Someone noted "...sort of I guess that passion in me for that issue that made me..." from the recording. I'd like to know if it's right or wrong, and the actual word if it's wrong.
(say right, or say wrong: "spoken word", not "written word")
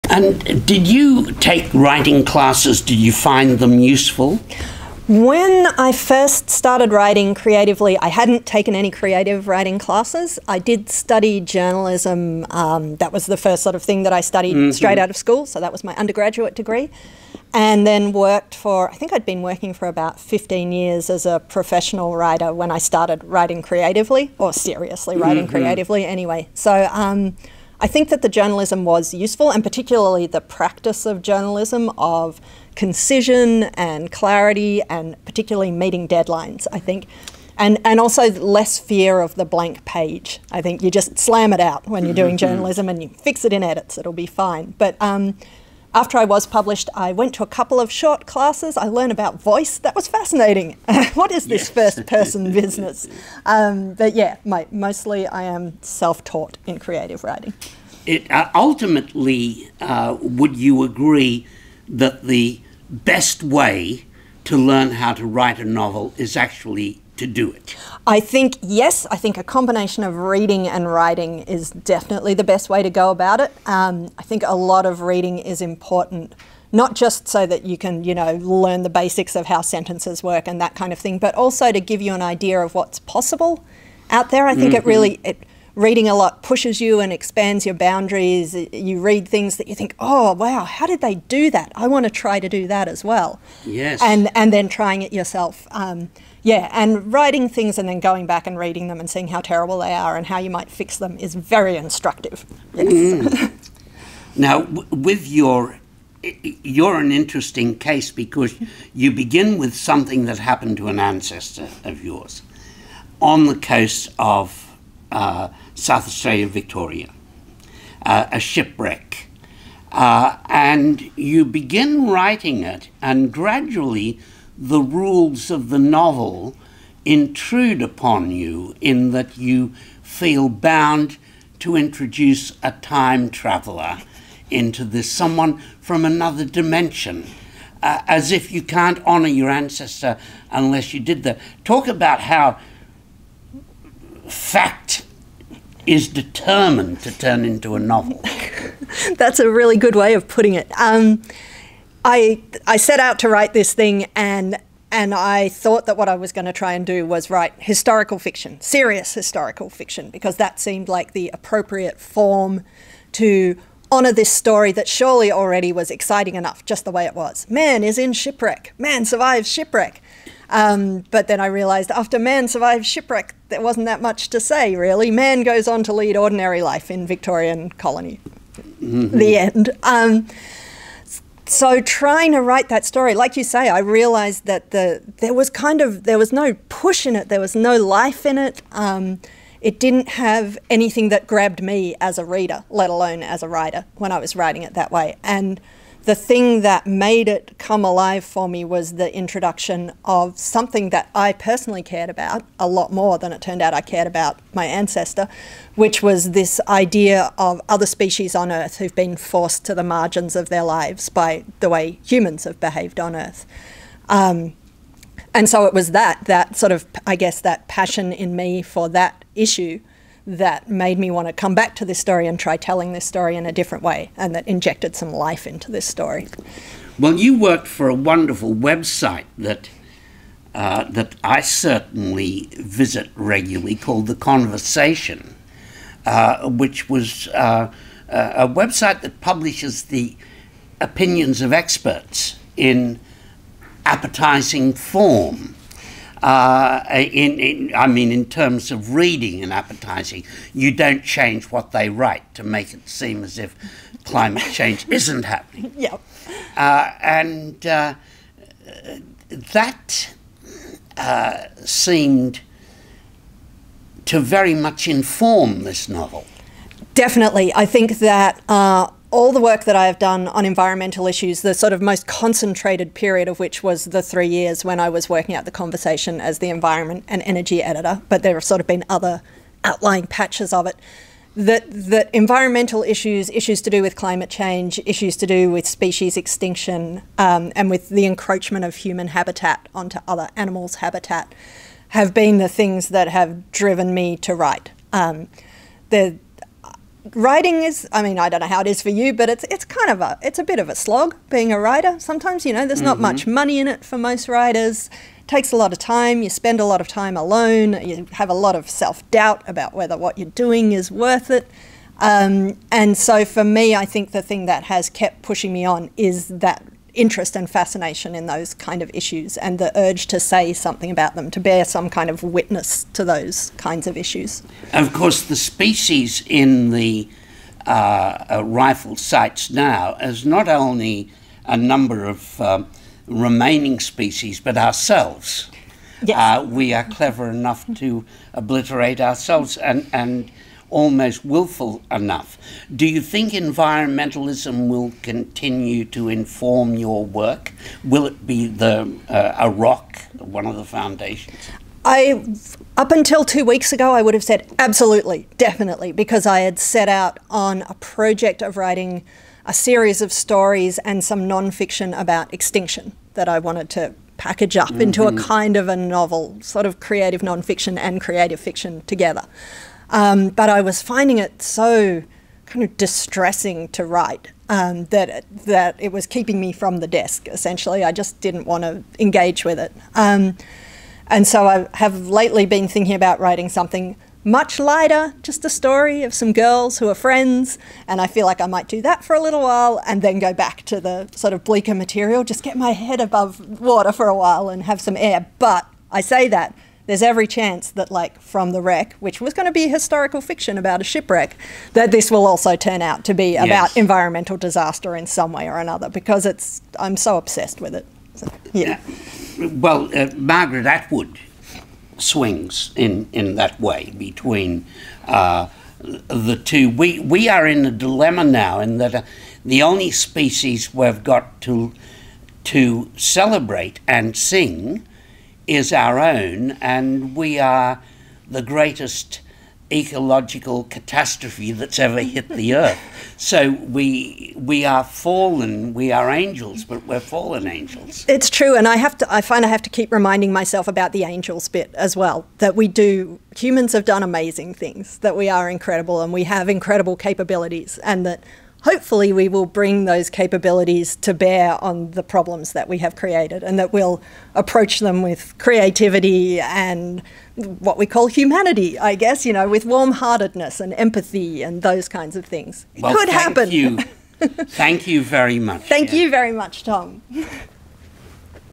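right.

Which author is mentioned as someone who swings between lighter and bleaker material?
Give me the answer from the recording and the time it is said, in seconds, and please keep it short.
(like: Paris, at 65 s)
Margaret Atwood, at 410 s.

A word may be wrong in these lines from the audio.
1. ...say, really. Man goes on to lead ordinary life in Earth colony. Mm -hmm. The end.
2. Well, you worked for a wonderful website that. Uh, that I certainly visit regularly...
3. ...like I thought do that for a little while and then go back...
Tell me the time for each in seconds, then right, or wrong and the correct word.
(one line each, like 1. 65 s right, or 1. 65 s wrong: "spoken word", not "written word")
1. 174 s wrong: "Victorian", not "Earth"
2. 226 s right
3. 388 s wrong: "might", not "thought".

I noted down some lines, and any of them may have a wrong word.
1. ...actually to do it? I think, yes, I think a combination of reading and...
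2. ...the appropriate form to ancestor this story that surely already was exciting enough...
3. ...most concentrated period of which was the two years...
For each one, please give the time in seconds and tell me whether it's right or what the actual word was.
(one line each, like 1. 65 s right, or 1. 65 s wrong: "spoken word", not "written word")
1. 66 s right
2. 161 s wrong: "honor", not "ancestor"
3. 271 s wrong: "three", not "two".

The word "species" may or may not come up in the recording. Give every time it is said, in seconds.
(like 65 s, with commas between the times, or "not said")
207 s, 285 s, 325 s, 333 s, 419 s.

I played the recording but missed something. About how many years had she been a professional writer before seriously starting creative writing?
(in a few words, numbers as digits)
15.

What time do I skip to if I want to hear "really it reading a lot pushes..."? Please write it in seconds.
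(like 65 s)
84 s.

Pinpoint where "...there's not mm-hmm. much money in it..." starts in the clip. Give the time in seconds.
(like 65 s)
302 s.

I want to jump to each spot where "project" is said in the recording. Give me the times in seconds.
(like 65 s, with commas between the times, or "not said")
357 s.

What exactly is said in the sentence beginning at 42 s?
journalism and you fix it in edits, it'll be fine.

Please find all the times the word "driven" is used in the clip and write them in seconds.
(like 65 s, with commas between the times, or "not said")
293 s.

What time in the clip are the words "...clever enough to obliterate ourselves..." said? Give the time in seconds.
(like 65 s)
336 s.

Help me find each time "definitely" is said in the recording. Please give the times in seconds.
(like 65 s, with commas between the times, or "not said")
71 s, 266 s, 355 s.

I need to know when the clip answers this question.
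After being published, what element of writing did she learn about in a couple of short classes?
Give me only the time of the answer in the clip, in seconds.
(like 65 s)
48 s.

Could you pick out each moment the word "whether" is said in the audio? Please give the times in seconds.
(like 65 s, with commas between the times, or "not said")
309 s.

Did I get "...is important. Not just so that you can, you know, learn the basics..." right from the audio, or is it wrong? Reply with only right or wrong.
right.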